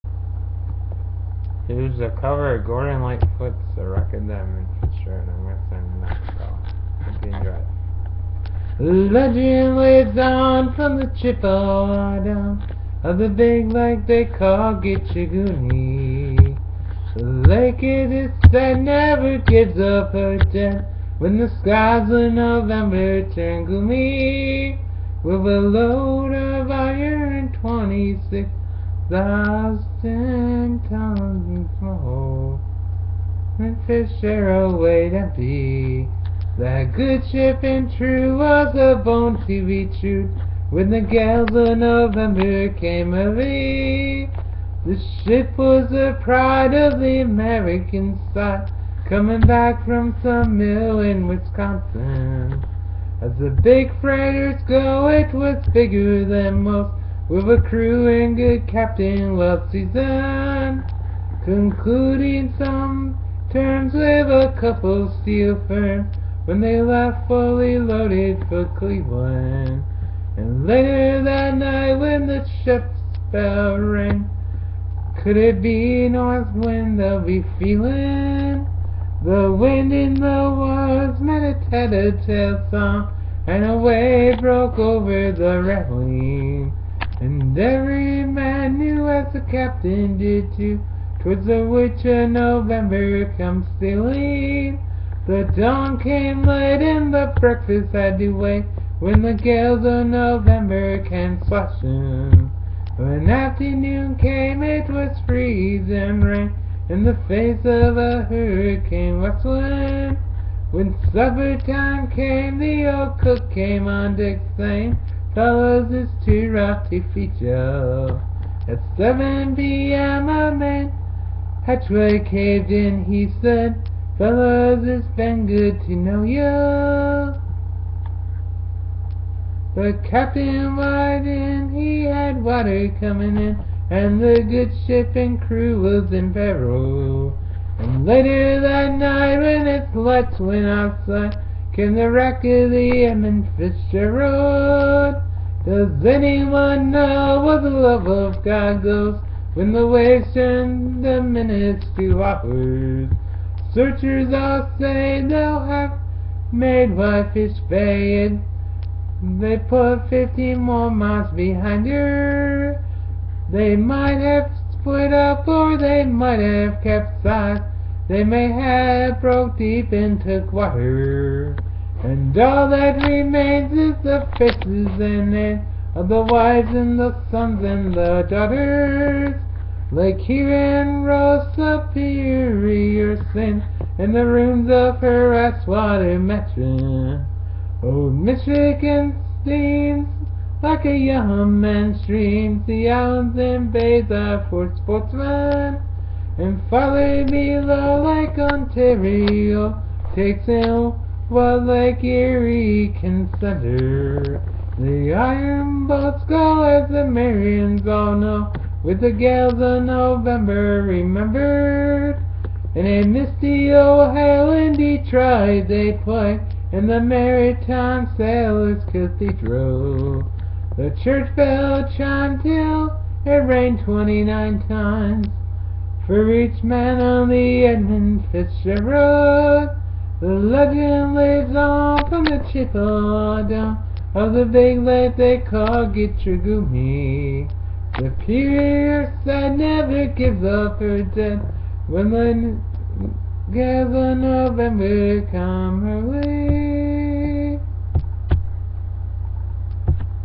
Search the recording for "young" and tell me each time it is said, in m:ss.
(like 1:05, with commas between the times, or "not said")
3:10.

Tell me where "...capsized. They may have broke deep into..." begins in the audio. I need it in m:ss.
2:46.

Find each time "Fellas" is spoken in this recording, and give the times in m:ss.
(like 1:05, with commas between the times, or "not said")
1:55, 2:04.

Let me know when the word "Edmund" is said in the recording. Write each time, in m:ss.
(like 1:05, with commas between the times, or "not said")
2:23, 3:47.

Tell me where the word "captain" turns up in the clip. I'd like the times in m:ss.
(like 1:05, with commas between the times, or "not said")
0:58, 1:29, 2:10.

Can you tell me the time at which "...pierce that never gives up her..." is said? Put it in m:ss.
3:58.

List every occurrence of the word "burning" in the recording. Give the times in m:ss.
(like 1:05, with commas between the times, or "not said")
not said.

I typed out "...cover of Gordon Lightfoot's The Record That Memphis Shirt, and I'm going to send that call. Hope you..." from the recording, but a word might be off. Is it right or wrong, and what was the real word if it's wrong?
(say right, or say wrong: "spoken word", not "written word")
right.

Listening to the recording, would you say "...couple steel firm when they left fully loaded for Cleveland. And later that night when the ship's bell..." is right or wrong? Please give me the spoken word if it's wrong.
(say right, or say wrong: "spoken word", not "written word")
right.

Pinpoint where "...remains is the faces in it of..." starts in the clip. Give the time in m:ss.
2:53.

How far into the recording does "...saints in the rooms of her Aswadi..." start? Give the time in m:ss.
3:03.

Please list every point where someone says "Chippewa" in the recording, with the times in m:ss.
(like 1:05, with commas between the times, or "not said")
0:11, 3:52.